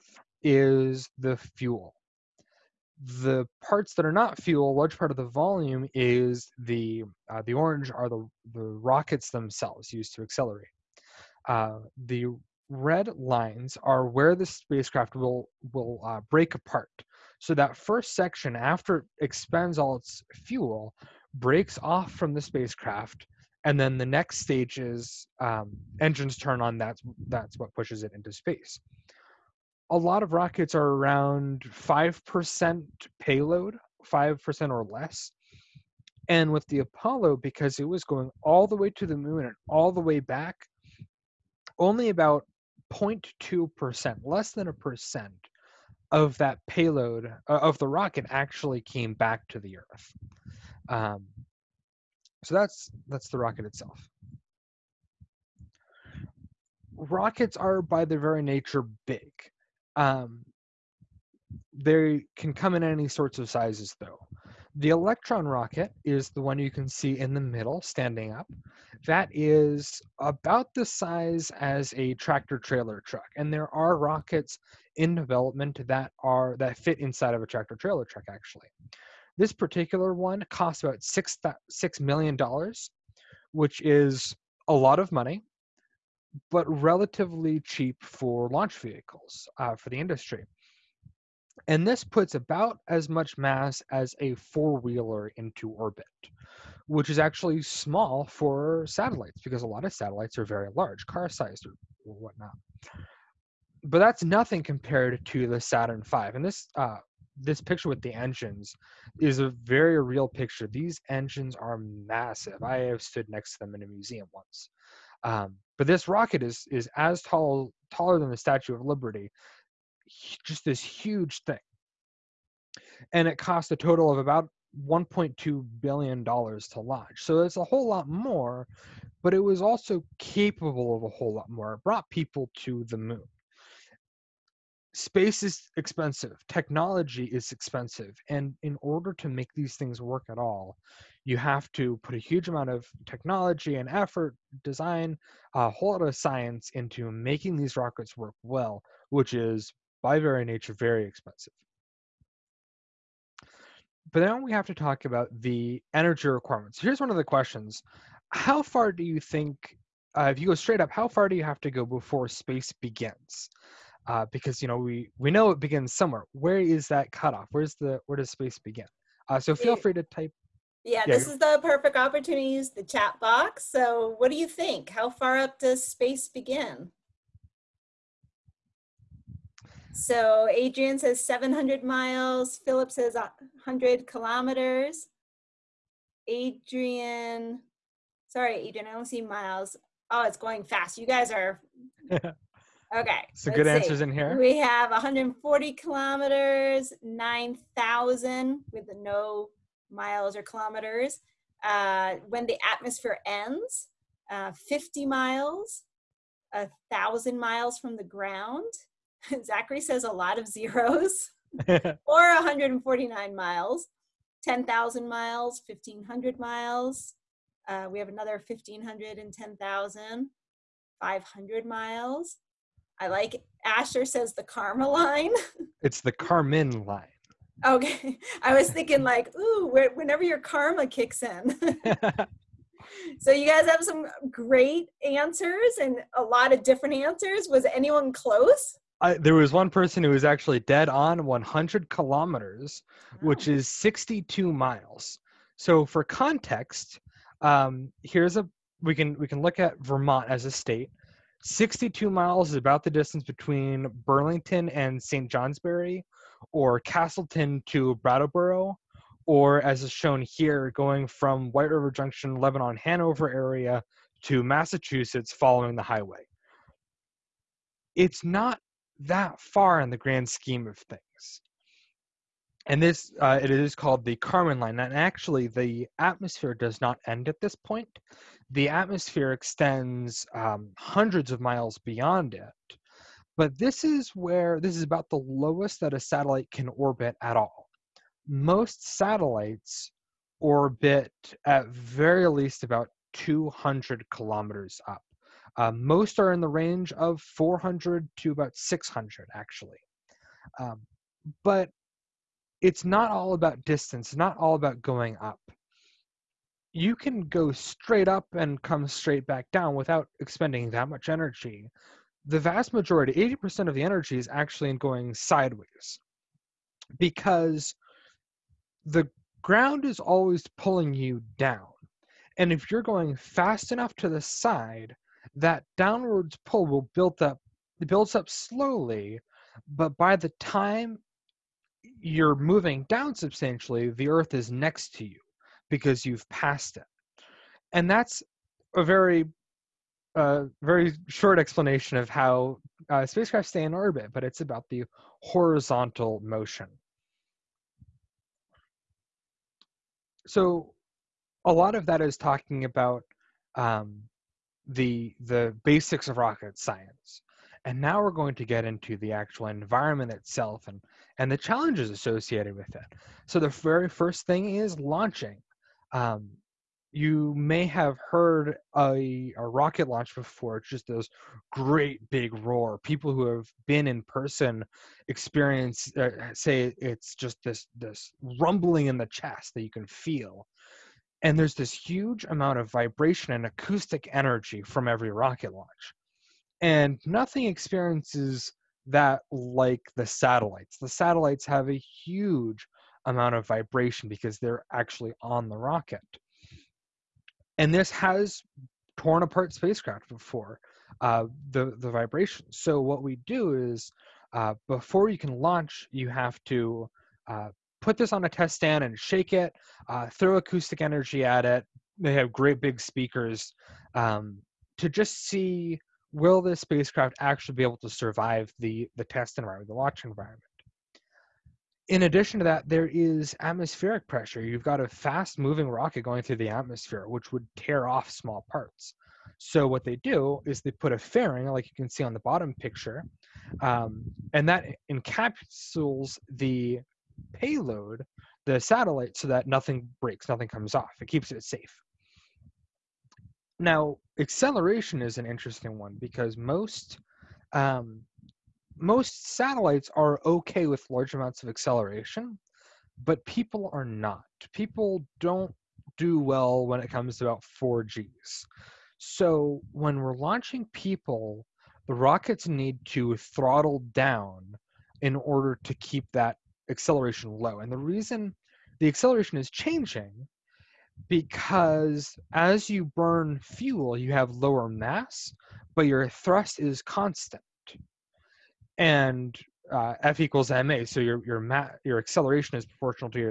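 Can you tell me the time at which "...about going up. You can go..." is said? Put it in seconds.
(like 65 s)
304 s.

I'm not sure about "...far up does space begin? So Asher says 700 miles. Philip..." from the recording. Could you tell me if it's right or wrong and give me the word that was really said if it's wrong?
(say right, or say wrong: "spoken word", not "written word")
wrong: "Adrian", not "Asher".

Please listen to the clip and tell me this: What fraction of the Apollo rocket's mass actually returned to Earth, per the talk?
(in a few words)
0.2%.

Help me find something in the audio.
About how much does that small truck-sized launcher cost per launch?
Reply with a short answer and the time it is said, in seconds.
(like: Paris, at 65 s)
6 million dollars, at 81 s.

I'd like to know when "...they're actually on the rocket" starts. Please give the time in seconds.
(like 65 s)
394 s.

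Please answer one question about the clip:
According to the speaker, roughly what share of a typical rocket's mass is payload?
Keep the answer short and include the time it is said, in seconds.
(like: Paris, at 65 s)
5%, at 34 s.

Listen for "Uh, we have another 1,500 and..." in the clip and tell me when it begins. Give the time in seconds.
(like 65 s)
217 s.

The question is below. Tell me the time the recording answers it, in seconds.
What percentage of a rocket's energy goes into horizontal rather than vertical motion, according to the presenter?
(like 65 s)
313 s.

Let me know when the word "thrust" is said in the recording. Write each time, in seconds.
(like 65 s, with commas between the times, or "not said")
476 s.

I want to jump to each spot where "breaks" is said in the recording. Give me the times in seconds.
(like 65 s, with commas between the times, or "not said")
16 s, 21 s, 440 s.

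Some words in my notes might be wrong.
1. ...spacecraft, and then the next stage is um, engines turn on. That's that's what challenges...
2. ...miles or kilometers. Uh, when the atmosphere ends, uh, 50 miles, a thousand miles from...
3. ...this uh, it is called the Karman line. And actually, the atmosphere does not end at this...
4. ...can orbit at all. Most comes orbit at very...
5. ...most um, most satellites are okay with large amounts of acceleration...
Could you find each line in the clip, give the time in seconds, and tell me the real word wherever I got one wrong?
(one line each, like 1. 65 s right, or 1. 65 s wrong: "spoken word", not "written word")
1. 22 s wrong: "pushes", not "challenges"
2. 199 s right
3. 272 s right
4. 286 s wrong: "satellites", not "comes"
5. 446 s right.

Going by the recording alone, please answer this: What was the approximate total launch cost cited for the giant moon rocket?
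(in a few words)
1.2 billion dollars.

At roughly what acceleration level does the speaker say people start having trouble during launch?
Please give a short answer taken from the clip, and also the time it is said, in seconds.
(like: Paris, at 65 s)
4 Gs, at 457 s.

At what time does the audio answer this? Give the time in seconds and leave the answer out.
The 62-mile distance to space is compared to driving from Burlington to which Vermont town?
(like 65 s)
255 s.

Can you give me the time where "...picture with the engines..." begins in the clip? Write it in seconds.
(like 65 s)
107 s.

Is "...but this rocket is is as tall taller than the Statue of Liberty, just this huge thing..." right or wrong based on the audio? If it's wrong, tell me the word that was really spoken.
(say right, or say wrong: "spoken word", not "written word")
right.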